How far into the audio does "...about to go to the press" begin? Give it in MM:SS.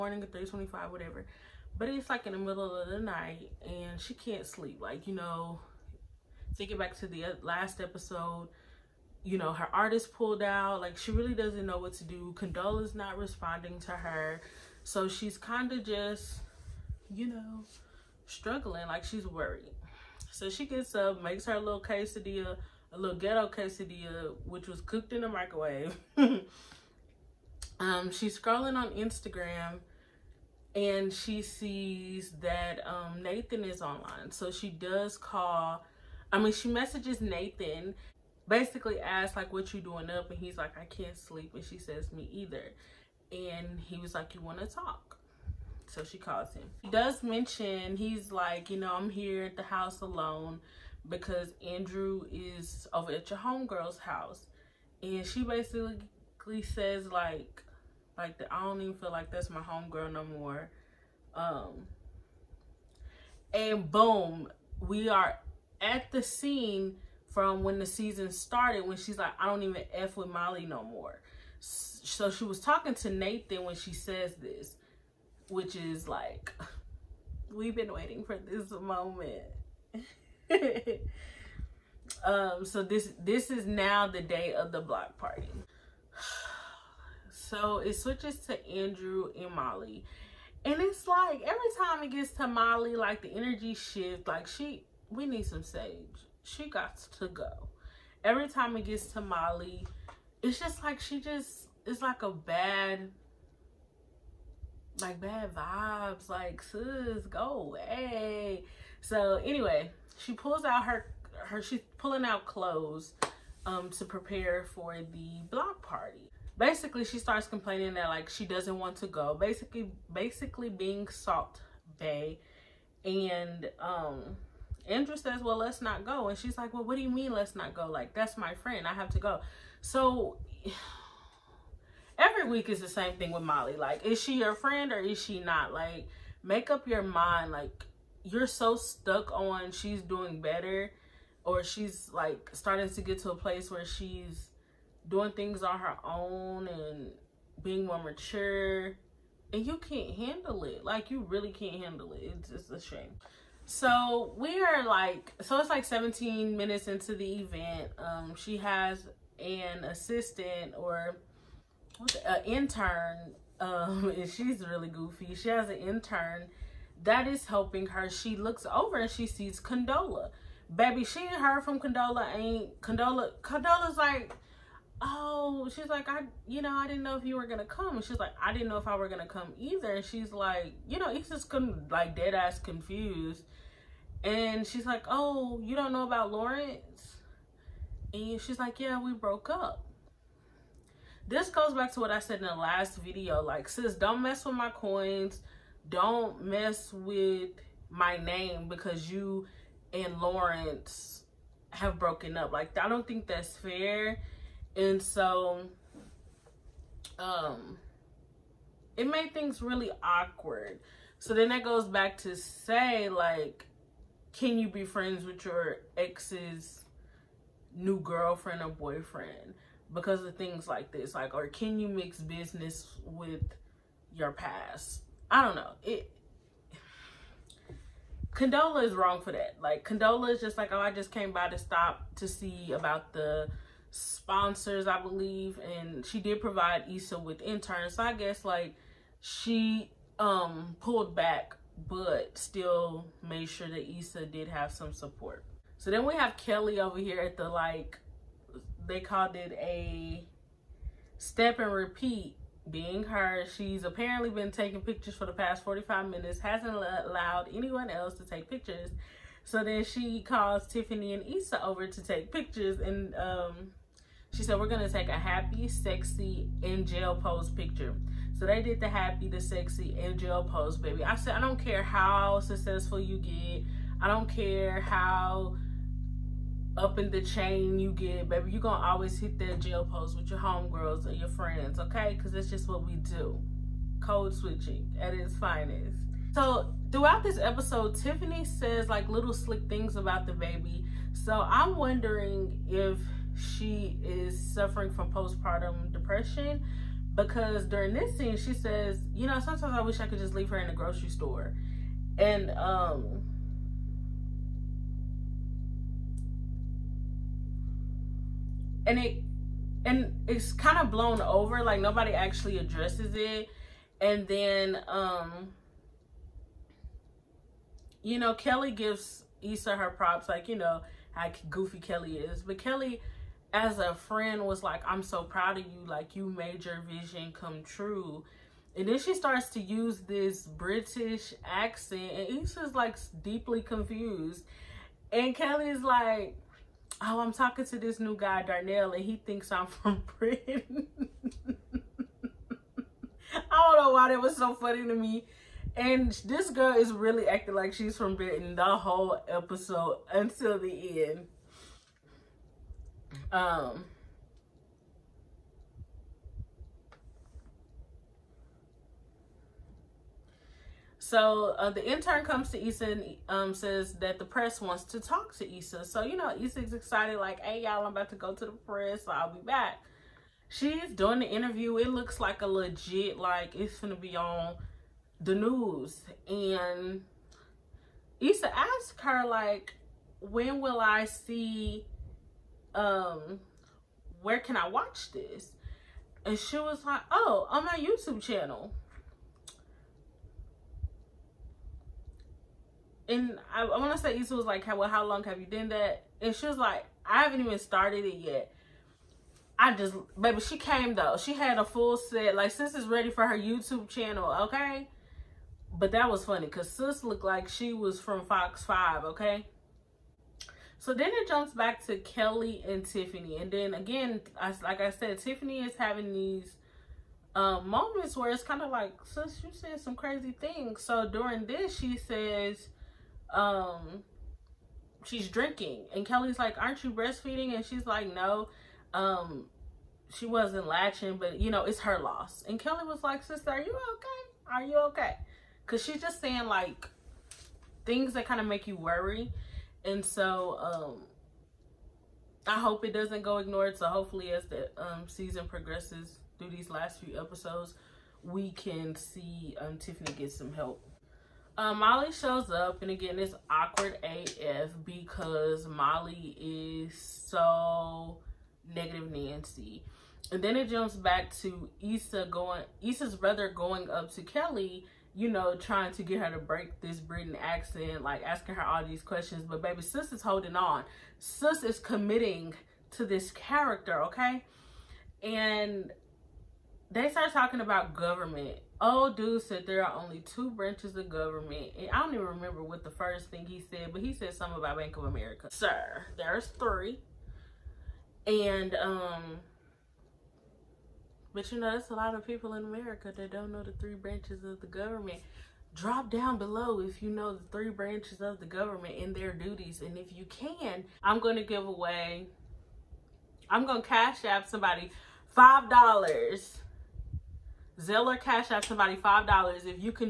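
06:07.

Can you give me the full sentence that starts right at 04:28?
So they did the happy, the sexy, in jail pose, baby.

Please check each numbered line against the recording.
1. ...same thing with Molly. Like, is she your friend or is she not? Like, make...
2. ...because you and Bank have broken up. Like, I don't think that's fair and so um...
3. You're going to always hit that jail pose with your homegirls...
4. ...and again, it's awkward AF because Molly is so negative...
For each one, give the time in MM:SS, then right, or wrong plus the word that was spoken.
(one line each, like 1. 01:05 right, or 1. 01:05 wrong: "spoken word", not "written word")
1. 02:12 right
2. 03:18 wrong: "Lawrence", not "Bank"
3. 04:38 right
4. 07:32 right.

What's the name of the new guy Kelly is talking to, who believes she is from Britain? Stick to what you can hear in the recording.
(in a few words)
Darnell.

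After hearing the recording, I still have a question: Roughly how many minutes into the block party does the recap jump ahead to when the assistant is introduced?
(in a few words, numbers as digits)
17.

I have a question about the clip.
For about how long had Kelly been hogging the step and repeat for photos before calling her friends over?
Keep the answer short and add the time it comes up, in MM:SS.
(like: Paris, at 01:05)
45 minutes, at 04:15.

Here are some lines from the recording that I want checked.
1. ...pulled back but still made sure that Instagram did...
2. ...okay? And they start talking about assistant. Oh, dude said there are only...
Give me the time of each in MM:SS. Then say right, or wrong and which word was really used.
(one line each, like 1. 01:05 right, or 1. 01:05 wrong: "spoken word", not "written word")
1. 04:00 wrong: "Issa", not "Instagram"
2. 07:54 wrong: "government", not "assistant".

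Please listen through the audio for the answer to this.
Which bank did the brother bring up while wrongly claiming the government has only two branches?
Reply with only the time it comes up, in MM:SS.
08:04.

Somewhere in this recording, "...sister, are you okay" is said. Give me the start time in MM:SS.
07:13.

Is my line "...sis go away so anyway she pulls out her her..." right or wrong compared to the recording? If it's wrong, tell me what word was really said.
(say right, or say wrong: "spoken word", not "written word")
right.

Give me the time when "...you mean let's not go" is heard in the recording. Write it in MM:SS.
02:07.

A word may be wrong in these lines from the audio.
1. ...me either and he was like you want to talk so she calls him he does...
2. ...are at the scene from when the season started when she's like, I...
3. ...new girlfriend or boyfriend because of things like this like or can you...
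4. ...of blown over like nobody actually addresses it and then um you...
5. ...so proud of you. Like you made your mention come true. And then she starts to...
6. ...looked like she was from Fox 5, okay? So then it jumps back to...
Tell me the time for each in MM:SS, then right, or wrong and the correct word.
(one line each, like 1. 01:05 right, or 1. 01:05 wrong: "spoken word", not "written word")
1. 00:42 right
2. 01:05 right
3. 03:37 right
4. 05:10 right
5. 05:25 wrong: "vision", not "mention"
6. 06:47 right.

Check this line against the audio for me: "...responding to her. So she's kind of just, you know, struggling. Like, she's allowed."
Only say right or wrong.
wrong.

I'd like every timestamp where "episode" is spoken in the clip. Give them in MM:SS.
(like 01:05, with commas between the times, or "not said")
00:07, 04:47, 05:49, 07:27.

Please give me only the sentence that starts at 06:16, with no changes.
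And Issa asks her, like, when will I see um, where can I watch this?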